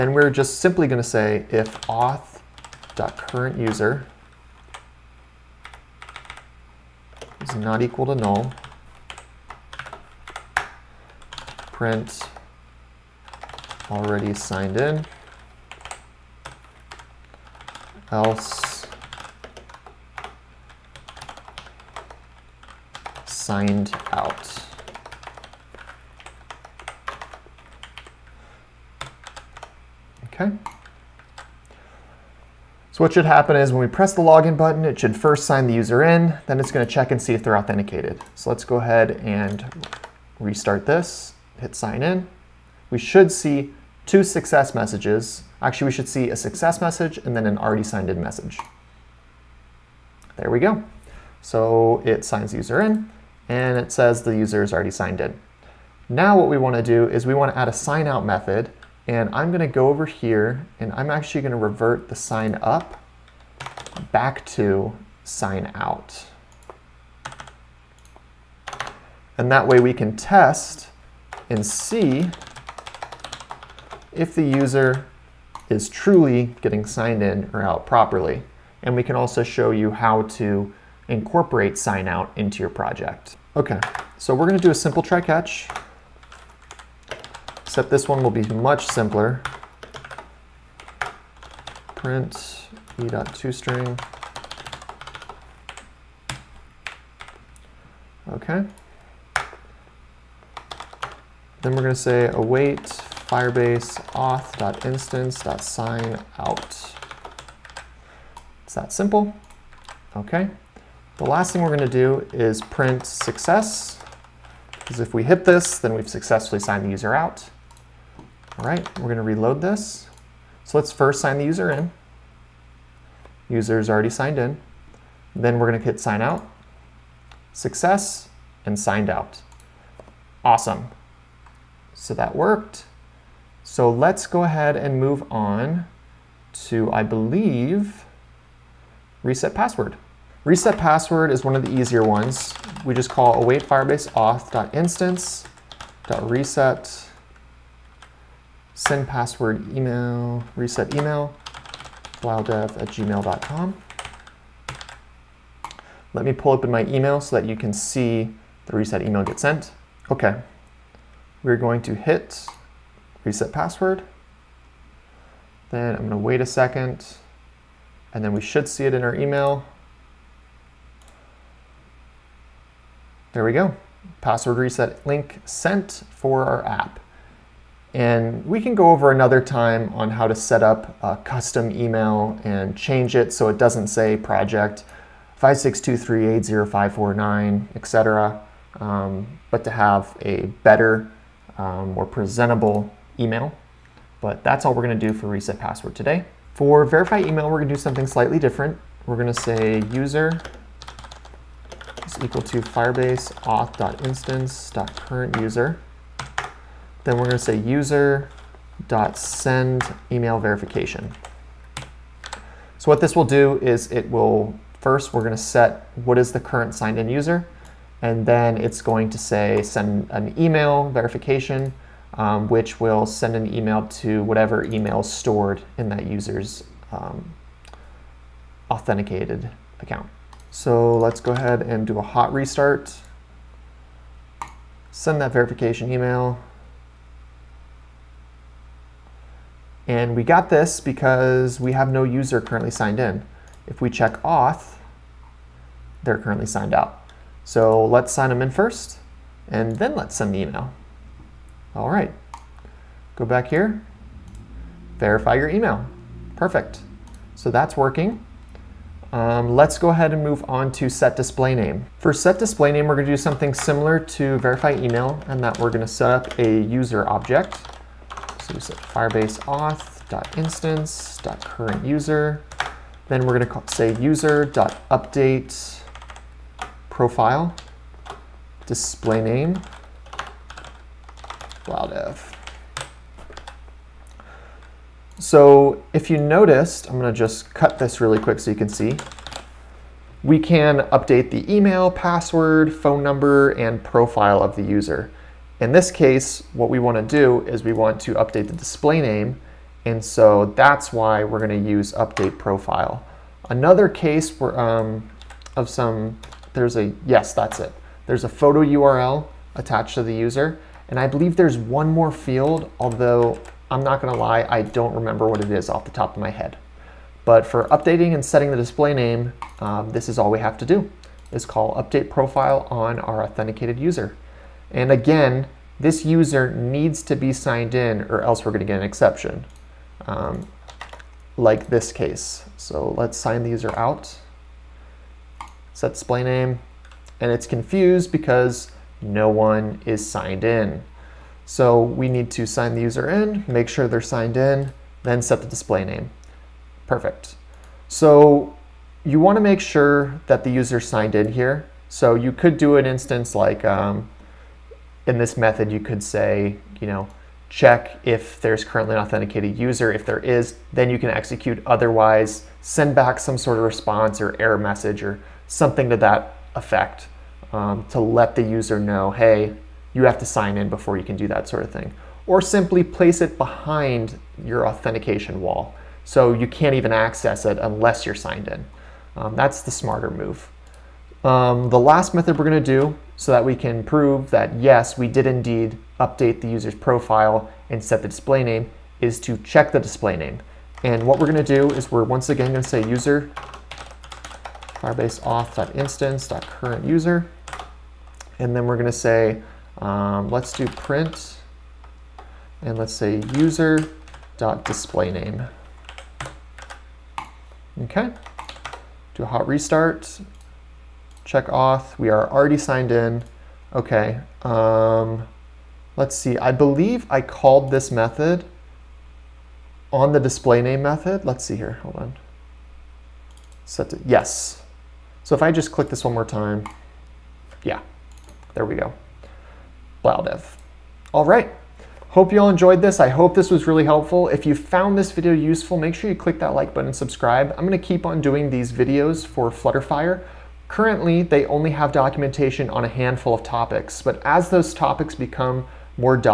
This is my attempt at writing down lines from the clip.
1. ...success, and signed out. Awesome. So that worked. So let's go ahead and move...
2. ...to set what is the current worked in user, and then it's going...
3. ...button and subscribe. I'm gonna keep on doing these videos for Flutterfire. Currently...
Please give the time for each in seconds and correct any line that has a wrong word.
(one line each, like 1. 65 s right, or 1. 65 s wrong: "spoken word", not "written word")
1. 127 s right
2. 215 s wrong: "signed", not "worked"
3. 436 s right.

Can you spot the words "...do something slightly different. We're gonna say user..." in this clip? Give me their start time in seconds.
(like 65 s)
197 s.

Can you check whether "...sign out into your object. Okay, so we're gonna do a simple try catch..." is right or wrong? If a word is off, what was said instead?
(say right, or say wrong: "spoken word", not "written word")
wrong: "project", not "object".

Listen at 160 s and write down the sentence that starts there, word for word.
Okay, we're going to hit reset password.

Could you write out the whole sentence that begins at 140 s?
Reset password is one of the easier ones.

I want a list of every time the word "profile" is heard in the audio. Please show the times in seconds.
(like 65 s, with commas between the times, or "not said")
276 s, 293 s, 302 s, 322 s, 386 s.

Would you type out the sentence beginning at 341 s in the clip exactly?
So we need to sign the user in, make sure they're signed in, then set the display name.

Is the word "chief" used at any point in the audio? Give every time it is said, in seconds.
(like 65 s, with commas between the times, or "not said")
not said.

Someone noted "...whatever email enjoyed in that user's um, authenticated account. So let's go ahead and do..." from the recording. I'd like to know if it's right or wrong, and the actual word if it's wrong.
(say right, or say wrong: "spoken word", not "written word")
wrong: "stored", not "enjoyed".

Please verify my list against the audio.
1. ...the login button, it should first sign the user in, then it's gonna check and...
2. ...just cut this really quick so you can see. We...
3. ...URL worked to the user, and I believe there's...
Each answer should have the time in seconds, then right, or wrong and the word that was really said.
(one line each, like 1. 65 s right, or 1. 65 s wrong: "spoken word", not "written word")
1. 34 s right
2. 287 s right
3. 308 s wrong: "attached", not "worked".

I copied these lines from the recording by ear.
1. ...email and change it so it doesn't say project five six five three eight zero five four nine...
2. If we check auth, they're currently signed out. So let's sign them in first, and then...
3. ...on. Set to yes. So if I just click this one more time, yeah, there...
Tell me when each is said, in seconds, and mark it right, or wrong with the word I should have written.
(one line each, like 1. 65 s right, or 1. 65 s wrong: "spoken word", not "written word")
1. 181 s wrong: "two", not "five"
2. 243 s right
3. 421 s right.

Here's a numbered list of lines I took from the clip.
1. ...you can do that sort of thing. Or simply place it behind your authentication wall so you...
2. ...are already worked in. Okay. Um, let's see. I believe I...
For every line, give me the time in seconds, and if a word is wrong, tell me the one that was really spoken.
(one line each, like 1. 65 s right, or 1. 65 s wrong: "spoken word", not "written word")
1. 370 s right
2. 412 s wrong: "signed", not "worked".